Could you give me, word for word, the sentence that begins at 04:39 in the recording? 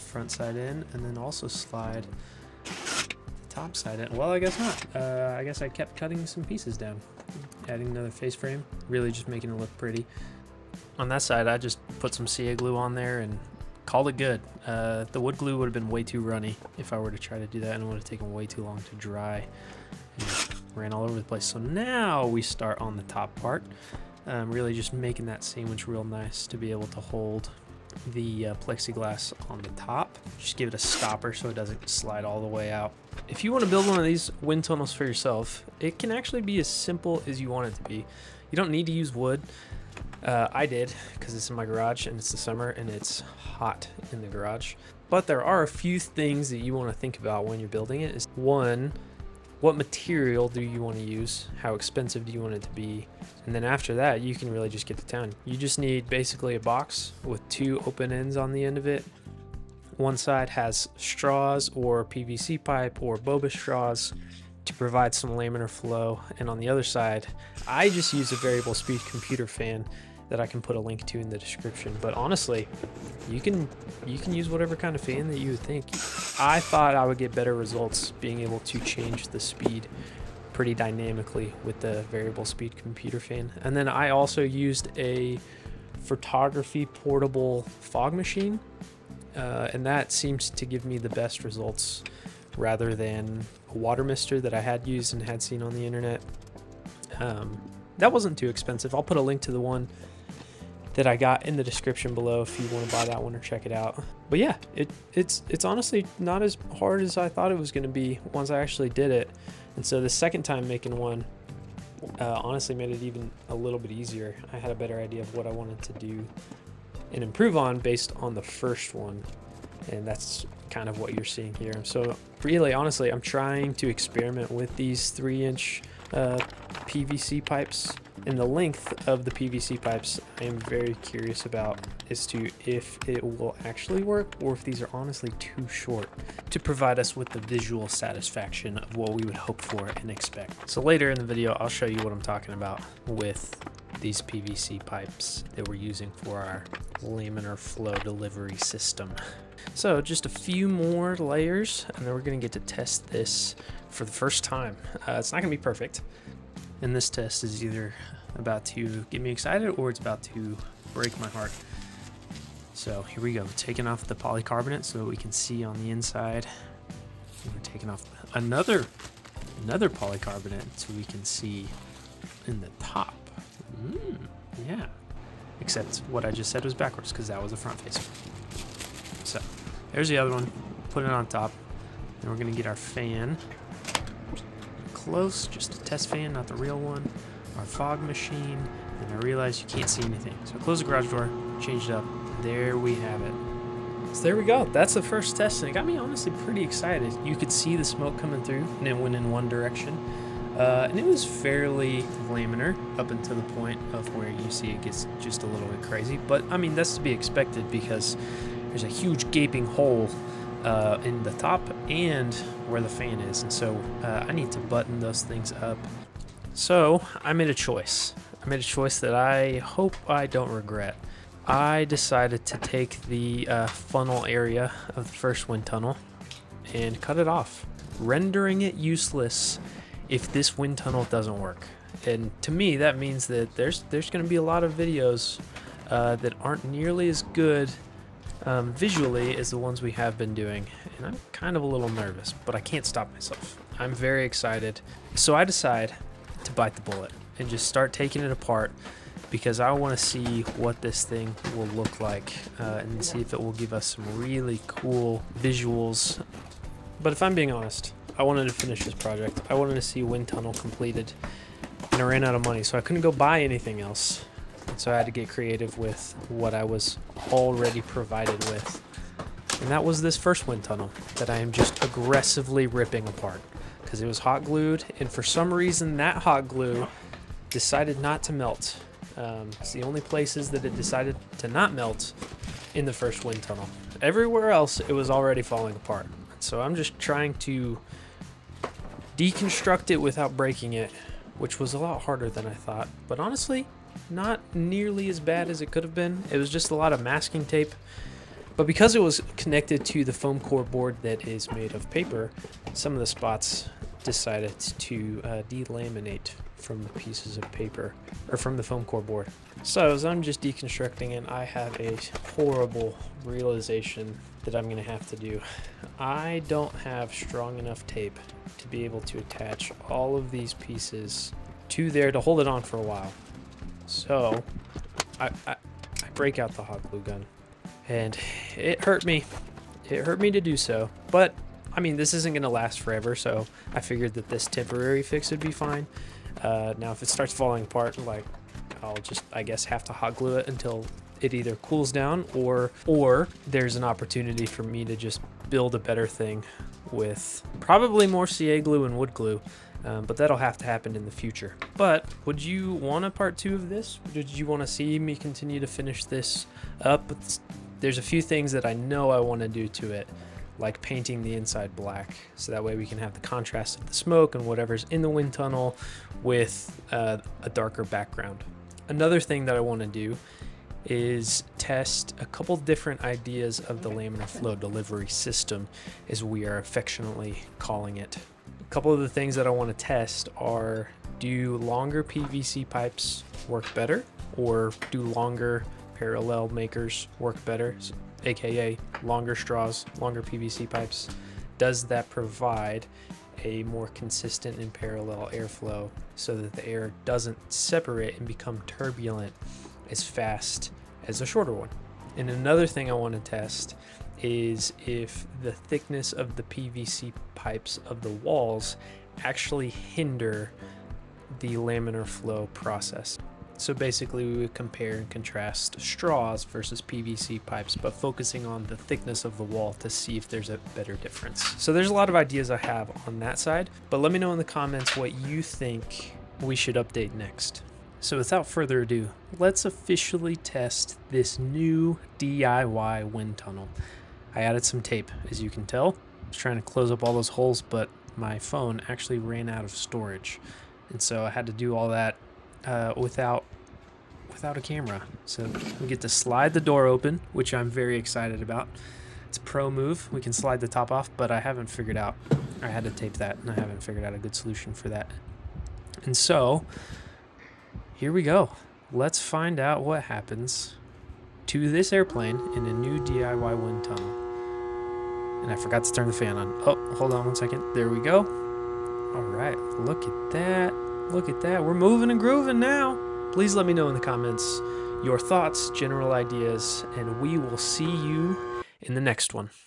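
Um, it's the only places that it decided to not melt in the first wind tunnel.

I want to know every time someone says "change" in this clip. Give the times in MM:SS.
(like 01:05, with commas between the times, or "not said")
01:18, 03:11.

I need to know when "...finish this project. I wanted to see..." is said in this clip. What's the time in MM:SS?
04:18.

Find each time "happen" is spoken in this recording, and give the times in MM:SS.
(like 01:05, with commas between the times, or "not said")
05:50, 07:40.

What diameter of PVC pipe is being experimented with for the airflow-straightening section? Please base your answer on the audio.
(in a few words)
3 inch.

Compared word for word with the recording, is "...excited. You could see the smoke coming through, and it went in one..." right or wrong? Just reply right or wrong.
right.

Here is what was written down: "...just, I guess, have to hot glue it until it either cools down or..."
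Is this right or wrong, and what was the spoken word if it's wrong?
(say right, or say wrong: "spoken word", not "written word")
right.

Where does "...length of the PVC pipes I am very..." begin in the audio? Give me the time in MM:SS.
02:08.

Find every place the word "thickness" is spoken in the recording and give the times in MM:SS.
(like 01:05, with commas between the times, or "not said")
06:45, 06:58.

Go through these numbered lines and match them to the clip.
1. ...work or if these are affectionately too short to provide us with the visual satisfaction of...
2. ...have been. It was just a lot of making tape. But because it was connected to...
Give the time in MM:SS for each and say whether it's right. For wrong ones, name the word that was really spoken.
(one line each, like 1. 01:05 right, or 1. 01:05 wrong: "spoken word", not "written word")
1. 02:14 wrong: "honestly", not "affectionately"
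2. 04:55 wrong: "masking", not "making".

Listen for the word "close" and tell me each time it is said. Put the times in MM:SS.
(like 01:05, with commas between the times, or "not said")
03:05, 07:16.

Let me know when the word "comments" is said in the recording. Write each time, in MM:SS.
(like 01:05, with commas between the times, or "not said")
07:04, 07:53.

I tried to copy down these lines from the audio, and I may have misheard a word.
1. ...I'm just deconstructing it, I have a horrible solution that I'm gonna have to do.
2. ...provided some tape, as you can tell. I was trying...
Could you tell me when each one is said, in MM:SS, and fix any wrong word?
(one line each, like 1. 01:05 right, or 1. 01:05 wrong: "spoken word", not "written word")
1. 05:10 wrong: "realization", not "solution"
2. 07:14 wrong: "added", not "provided".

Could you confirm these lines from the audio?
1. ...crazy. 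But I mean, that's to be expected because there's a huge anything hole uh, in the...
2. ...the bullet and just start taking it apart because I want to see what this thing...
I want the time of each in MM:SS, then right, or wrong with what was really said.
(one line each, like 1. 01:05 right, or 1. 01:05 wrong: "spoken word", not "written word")
1. 03:25 wrong: "gaping", not "anything"
2. 04:06 right.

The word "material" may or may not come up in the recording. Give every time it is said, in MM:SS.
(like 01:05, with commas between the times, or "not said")
00:49.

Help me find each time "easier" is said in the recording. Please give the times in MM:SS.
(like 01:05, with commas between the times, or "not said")
01:53.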